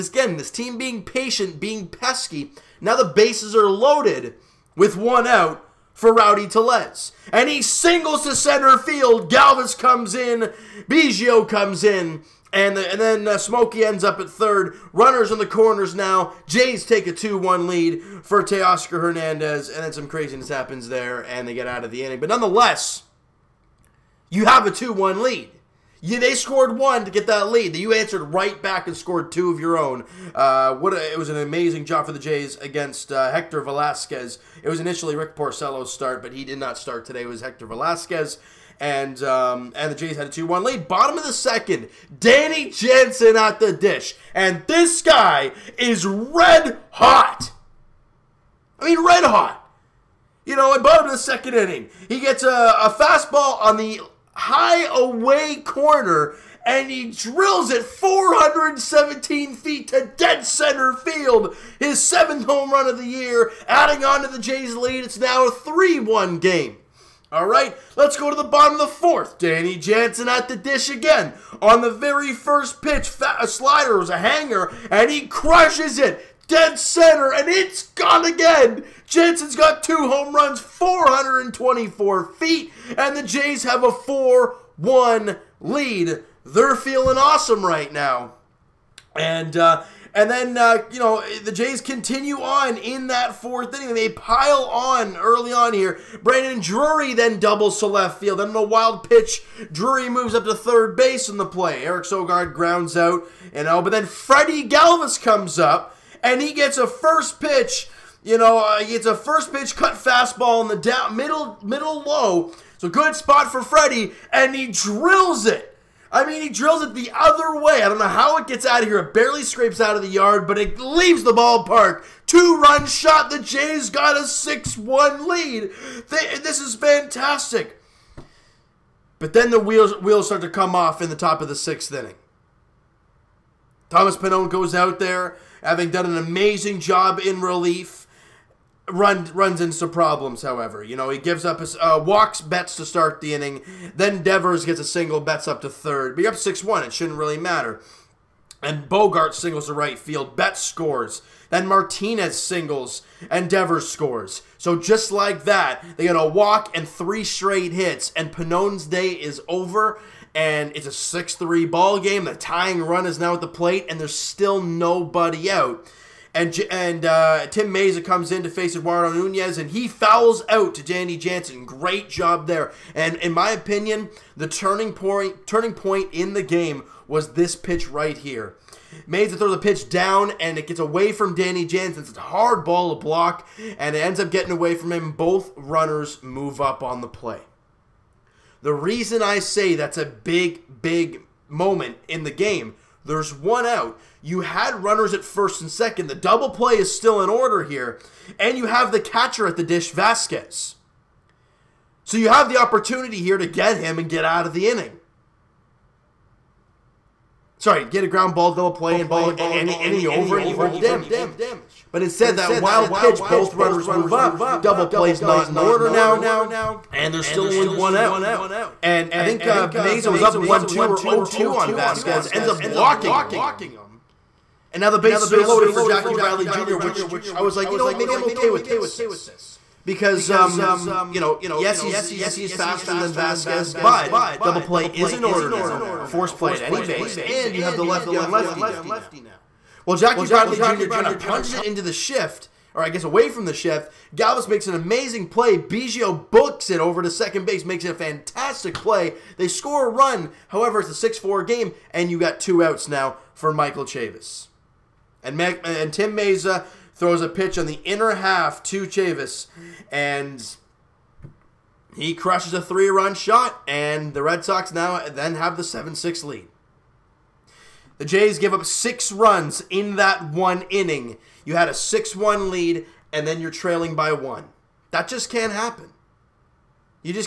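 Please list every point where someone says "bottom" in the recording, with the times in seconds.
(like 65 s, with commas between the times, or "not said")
40 s, 50 s, 68 s.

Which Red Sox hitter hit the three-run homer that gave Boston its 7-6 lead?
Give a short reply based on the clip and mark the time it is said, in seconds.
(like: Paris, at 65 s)
Michael Chavis, at 253 s.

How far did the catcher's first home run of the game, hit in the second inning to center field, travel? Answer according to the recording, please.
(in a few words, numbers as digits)
417 feet.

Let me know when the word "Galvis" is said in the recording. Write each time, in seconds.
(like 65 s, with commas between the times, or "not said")
9 s, 104 s, 244 s.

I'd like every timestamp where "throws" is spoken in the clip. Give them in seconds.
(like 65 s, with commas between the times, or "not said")
179 s, 256 s.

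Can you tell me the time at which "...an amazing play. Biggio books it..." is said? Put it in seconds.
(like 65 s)
244 s.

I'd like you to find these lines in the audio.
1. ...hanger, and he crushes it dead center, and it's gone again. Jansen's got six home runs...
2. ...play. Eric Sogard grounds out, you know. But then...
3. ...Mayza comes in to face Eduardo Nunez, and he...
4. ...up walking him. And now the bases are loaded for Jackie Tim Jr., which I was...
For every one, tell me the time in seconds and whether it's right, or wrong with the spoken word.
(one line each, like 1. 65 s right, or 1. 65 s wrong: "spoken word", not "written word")
1. 74 s wrong: "two", not "six"
2. 101 s right
3. 167 s right
4. 222 s wrong: "Bradley", not "Tim".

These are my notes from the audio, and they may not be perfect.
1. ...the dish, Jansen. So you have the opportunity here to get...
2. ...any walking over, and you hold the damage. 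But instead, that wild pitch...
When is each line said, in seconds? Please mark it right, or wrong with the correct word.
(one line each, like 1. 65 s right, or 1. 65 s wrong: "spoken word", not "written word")
1. 199 s wrong: "Vasquez", not "Jansen"
2. 209 s wrong: "inning", not "walking".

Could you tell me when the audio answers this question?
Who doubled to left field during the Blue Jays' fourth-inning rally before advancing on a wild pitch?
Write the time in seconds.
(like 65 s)
96 s.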